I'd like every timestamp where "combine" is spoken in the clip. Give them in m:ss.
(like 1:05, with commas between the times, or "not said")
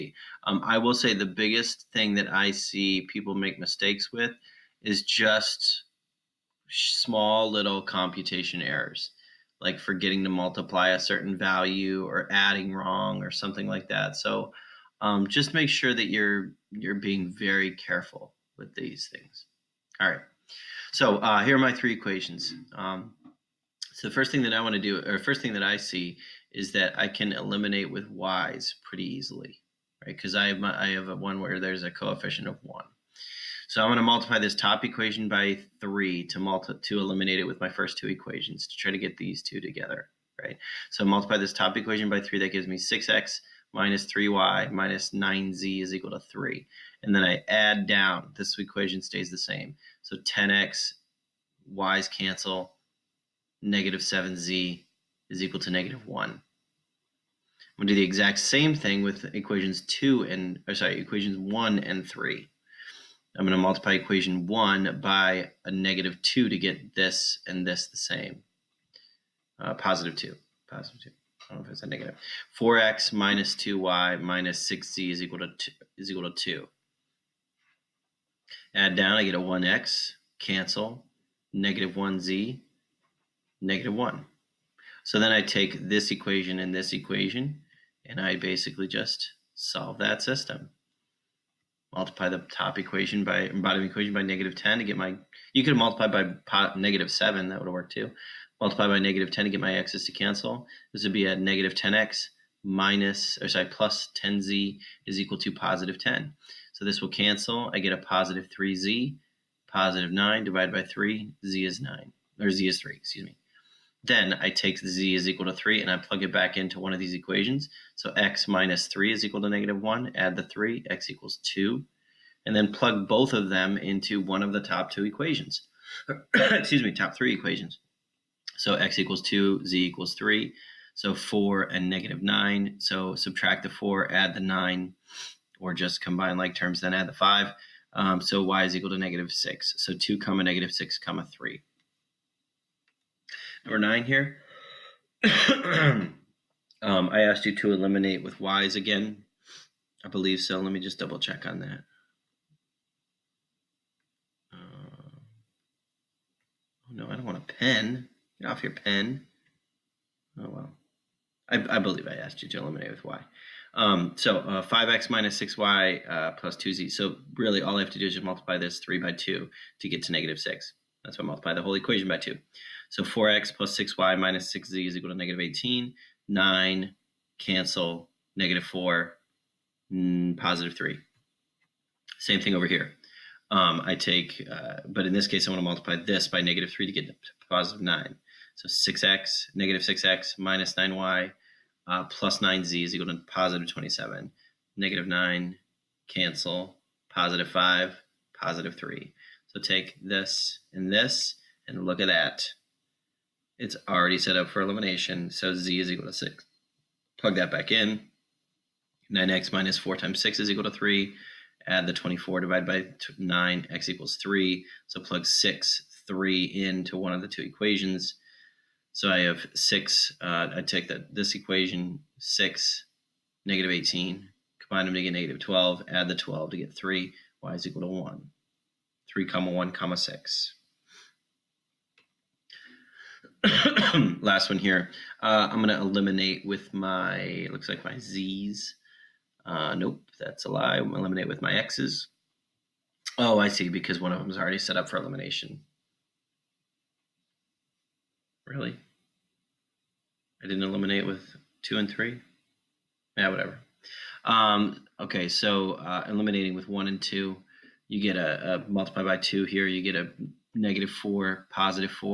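2:16, 3:44.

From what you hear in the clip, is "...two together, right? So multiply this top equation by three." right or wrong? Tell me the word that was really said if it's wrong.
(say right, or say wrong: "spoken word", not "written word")
right.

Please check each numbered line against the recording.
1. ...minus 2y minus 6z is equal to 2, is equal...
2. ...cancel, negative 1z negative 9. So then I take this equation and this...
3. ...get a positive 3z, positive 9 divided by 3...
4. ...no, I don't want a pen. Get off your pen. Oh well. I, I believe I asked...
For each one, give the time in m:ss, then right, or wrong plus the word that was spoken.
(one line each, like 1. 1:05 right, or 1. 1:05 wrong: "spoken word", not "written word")
1. 1:13 right
2. 1:20 wrong: "1", not "9"
3. 1:47 right
4. 2:36 right.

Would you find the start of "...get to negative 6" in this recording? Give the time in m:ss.
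2:49.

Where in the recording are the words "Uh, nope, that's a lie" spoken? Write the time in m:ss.
3:59.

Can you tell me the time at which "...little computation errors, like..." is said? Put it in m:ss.
0:07.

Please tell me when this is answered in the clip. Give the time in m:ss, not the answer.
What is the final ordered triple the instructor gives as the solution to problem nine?
3:49.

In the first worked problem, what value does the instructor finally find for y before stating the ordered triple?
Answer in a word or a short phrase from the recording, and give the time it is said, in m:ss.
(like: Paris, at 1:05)
-6, at 2:18.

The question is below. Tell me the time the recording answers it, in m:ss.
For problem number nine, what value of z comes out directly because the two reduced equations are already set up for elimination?
3:25.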